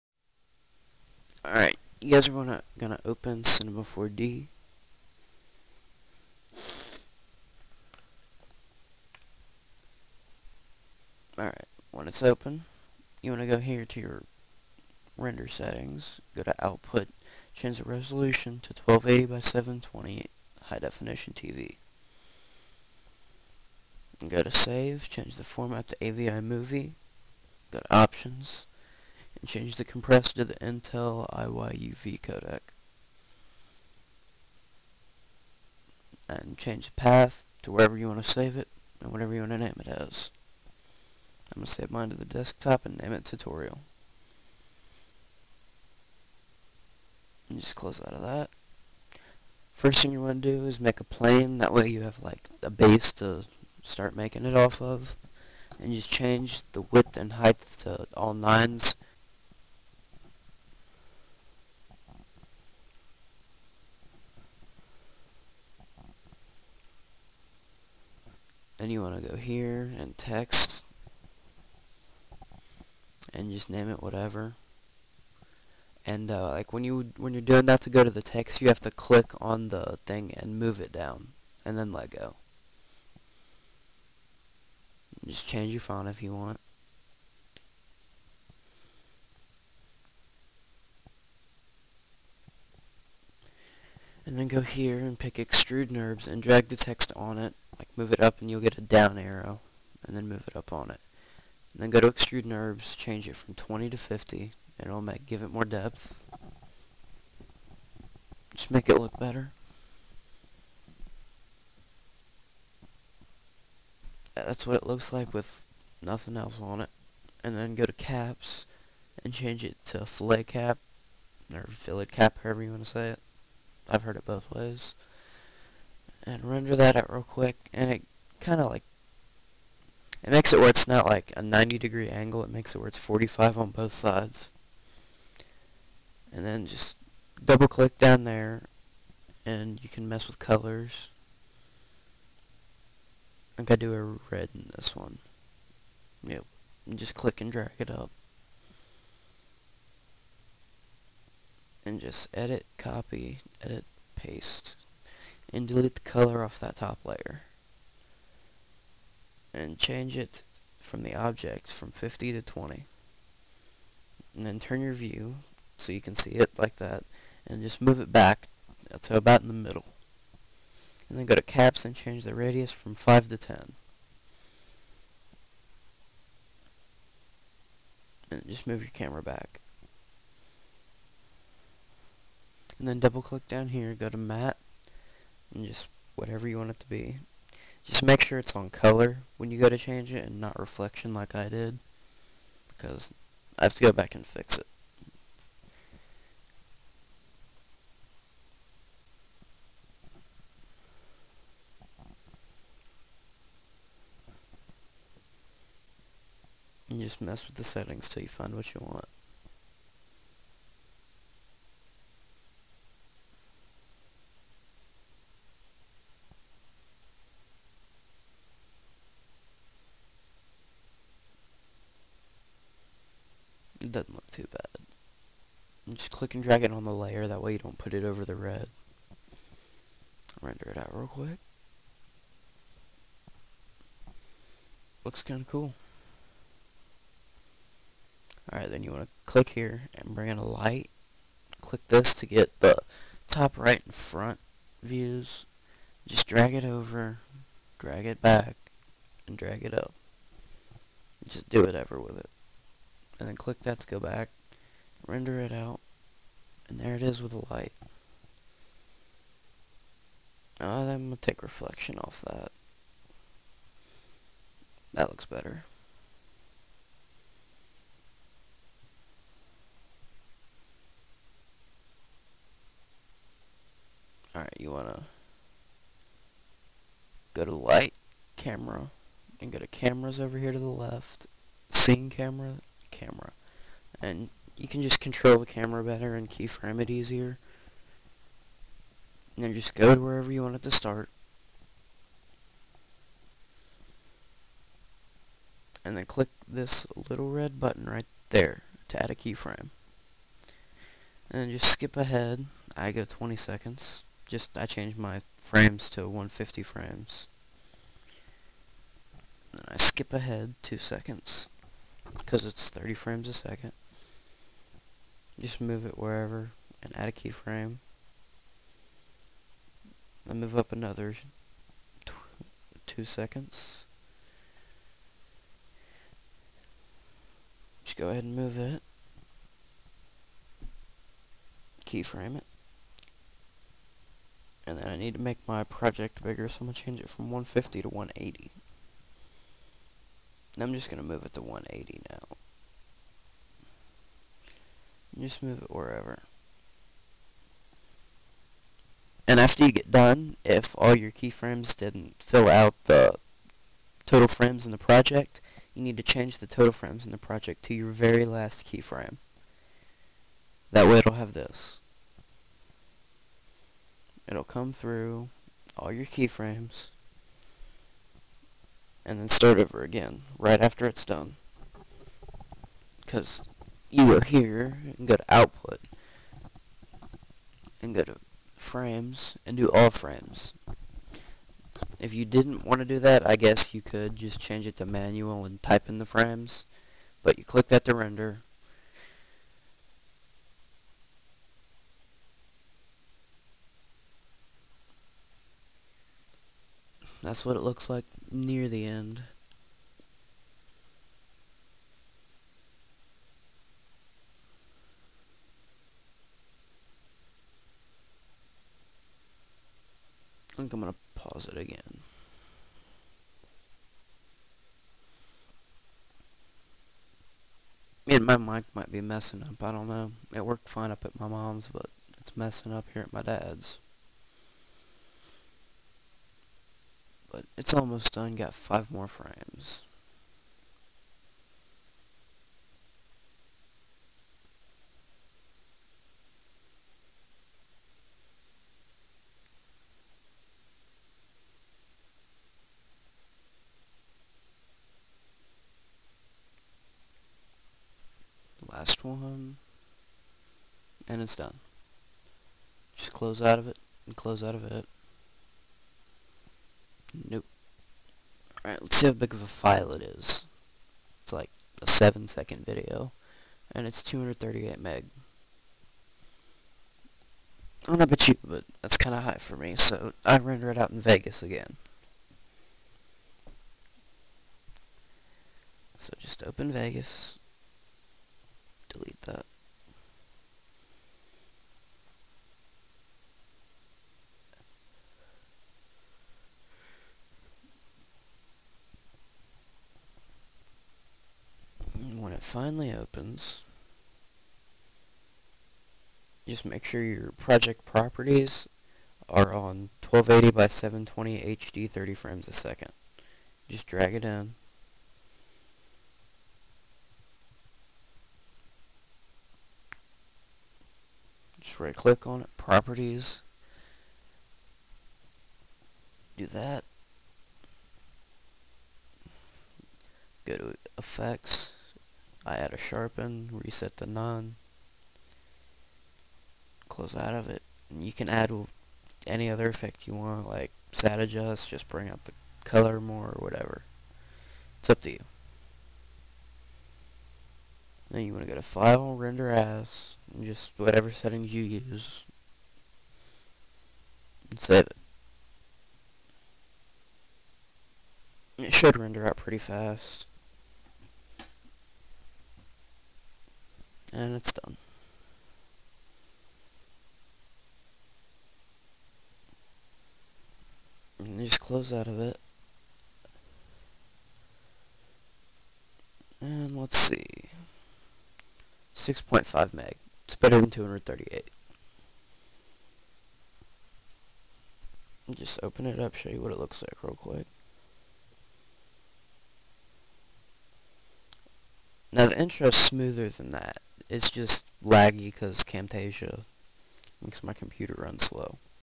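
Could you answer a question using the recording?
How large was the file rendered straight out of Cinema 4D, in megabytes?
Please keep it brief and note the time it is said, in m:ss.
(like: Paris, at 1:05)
238, at 7:44.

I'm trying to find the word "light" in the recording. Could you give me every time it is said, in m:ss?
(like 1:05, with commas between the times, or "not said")
4:00, 4:17, 4:37.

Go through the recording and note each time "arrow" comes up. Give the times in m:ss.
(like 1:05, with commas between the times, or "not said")
1:39.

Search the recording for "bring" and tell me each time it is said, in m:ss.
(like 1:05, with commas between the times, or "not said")
4:00, 8:51.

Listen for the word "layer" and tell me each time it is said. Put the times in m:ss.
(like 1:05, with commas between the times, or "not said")
2:37, 3:46.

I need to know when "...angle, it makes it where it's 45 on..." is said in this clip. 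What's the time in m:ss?
2:12.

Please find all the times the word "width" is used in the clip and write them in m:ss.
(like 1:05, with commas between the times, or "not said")
0:56.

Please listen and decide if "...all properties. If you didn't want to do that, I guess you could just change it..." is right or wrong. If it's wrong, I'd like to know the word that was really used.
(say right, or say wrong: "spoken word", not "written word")
wrong: "frames", not "properties".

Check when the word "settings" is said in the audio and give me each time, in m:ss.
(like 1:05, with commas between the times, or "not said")
0:15, 3:27, 9:01.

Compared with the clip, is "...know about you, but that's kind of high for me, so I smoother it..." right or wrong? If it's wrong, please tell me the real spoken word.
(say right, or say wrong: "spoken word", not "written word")
wrong: "render", not "smoother".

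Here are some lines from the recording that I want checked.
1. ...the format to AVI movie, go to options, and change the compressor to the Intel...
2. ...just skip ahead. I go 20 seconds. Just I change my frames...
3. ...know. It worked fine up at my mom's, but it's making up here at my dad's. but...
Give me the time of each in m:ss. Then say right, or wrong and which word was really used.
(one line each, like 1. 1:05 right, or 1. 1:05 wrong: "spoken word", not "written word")
1. 0:25 right
2. 5:01 right
3. 6:59 wrong: "messing", not "making".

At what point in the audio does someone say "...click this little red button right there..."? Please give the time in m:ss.
4:56.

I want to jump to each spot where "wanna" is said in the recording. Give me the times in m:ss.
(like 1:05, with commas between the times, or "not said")
0:13.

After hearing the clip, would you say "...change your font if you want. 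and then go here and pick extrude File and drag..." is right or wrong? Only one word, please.
wrong.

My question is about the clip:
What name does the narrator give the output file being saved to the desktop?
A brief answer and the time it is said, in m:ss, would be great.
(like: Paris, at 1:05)
tutorial, at 0:43.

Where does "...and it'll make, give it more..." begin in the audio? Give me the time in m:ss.
1:44.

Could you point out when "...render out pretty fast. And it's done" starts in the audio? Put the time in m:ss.
9:08.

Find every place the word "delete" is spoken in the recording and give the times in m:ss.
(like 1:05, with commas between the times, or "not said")
2:35, 7:58.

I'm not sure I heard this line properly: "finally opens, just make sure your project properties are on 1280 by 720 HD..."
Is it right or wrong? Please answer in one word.
right.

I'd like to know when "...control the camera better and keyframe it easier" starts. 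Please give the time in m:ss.
4:44.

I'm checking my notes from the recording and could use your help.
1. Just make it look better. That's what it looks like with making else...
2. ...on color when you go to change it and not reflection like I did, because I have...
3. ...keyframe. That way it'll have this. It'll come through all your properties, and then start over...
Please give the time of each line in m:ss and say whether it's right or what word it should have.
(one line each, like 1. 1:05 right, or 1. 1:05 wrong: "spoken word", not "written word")
1. 1:48 wrong: "nothing", not "making"
2. 3:08 right
3. 5:58 wrong: "keyframes", not "properties".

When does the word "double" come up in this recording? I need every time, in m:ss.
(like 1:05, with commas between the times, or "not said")
2:17, 3:02.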